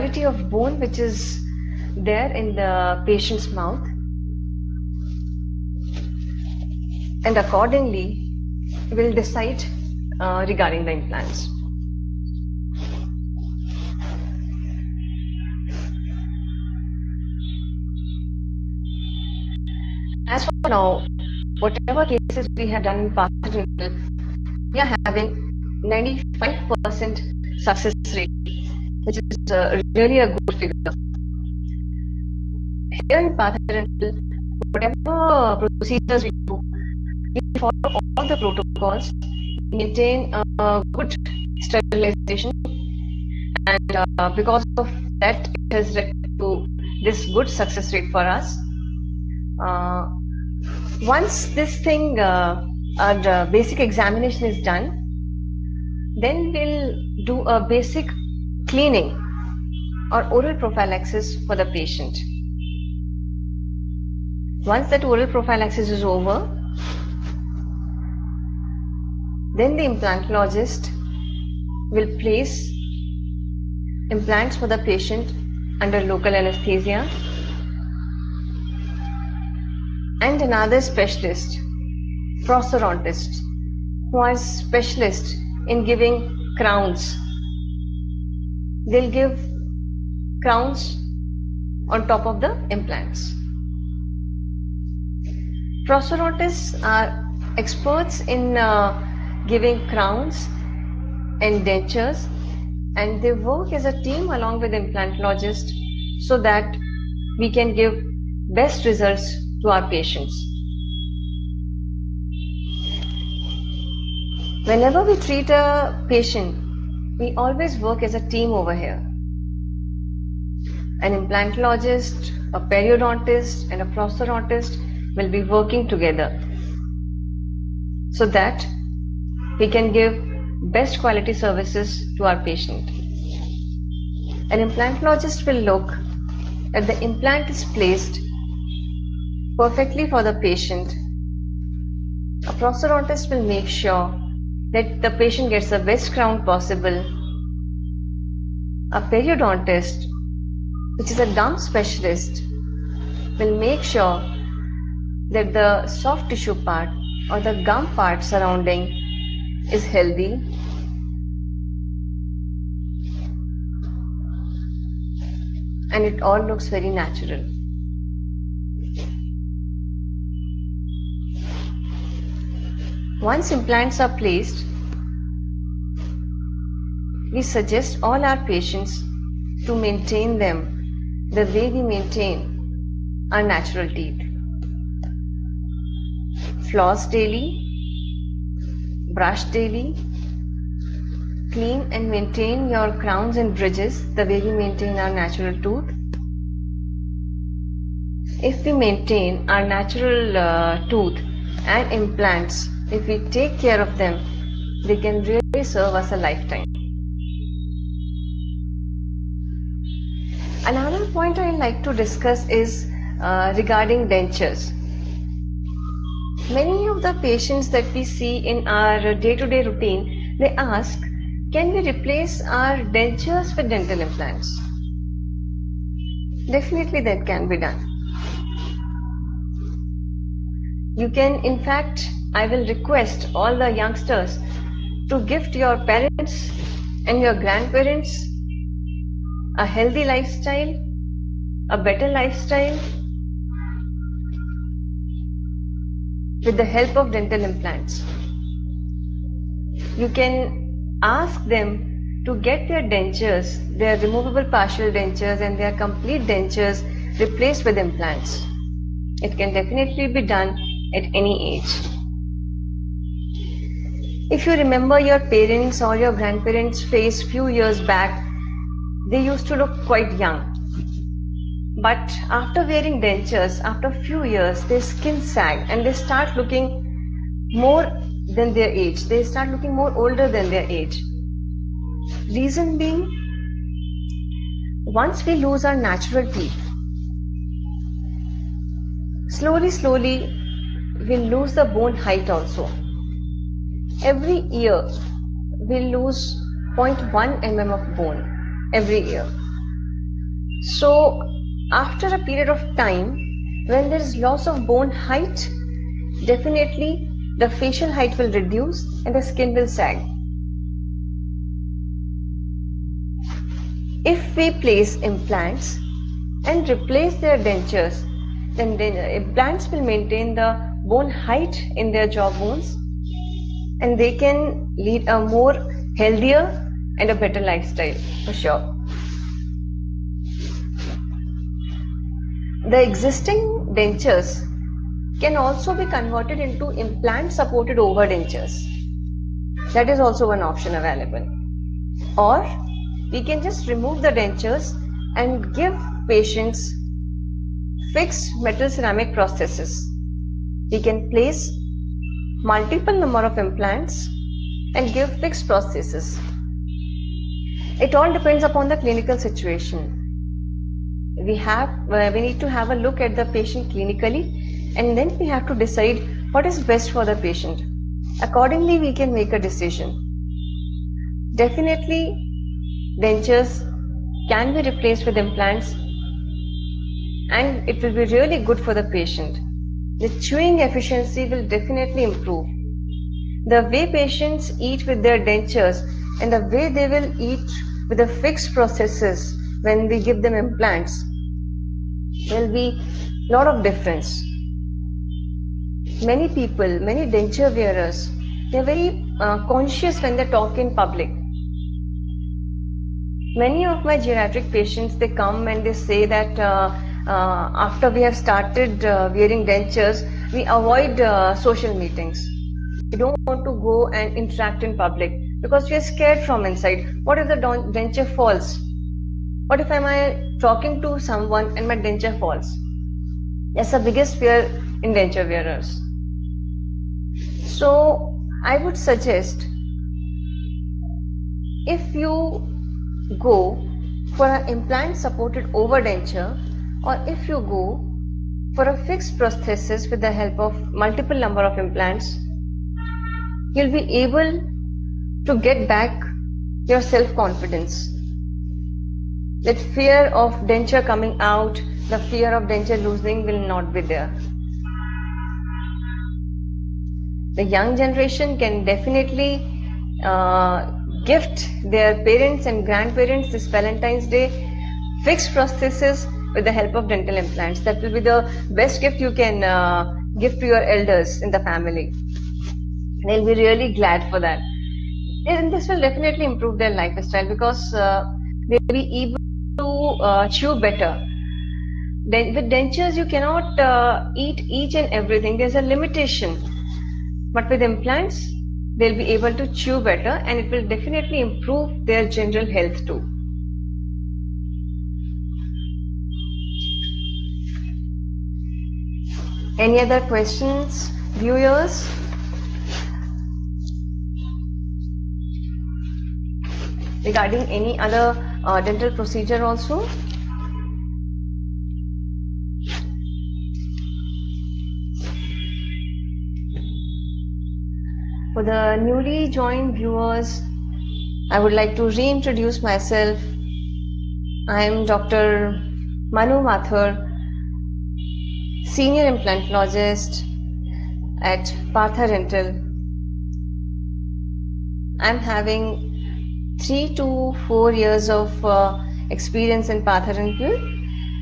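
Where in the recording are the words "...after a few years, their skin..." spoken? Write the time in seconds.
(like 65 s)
273 s.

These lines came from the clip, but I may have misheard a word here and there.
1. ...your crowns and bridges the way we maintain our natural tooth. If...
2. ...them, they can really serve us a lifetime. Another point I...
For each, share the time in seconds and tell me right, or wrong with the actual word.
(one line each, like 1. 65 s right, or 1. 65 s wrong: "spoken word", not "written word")
1. 192 s right
2. 203 s right.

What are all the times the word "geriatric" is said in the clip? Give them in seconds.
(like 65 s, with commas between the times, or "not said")
403 s.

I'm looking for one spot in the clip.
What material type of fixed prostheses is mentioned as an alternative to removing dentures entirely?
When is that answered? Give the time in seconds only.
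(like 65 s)
348 s.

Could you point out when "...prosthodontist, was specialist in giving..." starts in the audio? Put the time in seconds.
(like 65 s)
82 s.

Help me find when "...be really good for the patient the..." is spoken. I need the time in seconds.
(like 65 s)
377 s.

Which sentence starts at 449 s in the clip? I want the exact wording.
That fear of denture coming out, the fear of denture losing will not be there.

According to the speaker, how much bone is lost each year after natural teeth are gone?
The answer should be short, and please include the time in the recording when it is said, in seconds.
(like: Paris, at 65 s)
0.1 mm, at 296 s.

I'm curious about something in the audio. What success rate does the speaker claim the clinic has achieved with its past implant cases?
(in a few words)
95%.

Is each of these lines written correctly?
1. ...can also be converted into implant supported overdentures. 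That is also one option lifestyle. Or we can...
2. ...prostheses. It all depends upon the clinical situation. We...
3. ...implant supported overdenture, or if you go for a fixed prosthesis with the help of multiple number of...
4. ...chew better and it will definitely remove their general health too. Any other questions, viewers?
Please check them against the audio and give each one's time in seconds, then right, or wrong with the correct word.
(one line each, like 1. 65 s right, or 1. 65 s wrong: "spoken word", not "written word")
1. 335 s wrong: "available", not "lifestyle"
2. 355 s right
3. 434 s right
4. 489 s wrong: "improve", not "remove".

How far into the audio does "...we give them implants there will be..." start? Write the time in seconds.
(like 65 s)
389 s.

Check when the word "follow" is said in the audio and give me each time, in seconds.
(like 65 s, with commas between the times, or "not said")
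37 s.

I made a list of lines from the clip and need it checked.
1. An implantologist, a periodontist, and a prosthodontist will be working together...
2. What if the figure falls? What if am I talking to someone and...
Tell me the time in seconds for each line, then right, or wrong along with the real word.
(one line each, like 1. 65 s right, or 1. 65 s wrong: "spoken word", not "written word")
1. 121 s right
2. 417 s wrong: "denture", not "figure".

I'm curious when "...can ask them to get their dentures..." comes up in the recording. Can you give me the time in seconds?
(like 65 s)
250 s.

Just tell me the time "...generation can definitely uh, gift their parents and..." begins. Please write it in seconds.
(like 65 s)
457 s.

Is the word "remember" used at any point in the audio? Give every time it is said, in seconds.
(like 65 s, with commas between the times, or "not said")
264 s.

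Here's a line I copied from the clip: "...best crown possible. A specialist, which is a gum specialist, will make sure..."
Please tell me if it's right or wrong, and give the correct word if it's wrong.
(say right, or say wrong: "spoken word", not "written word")
wrong: "periodontist", not "specialist".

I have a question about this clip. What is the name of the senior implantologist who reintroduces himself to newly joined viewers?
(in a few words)
Dr. Manu Mathur.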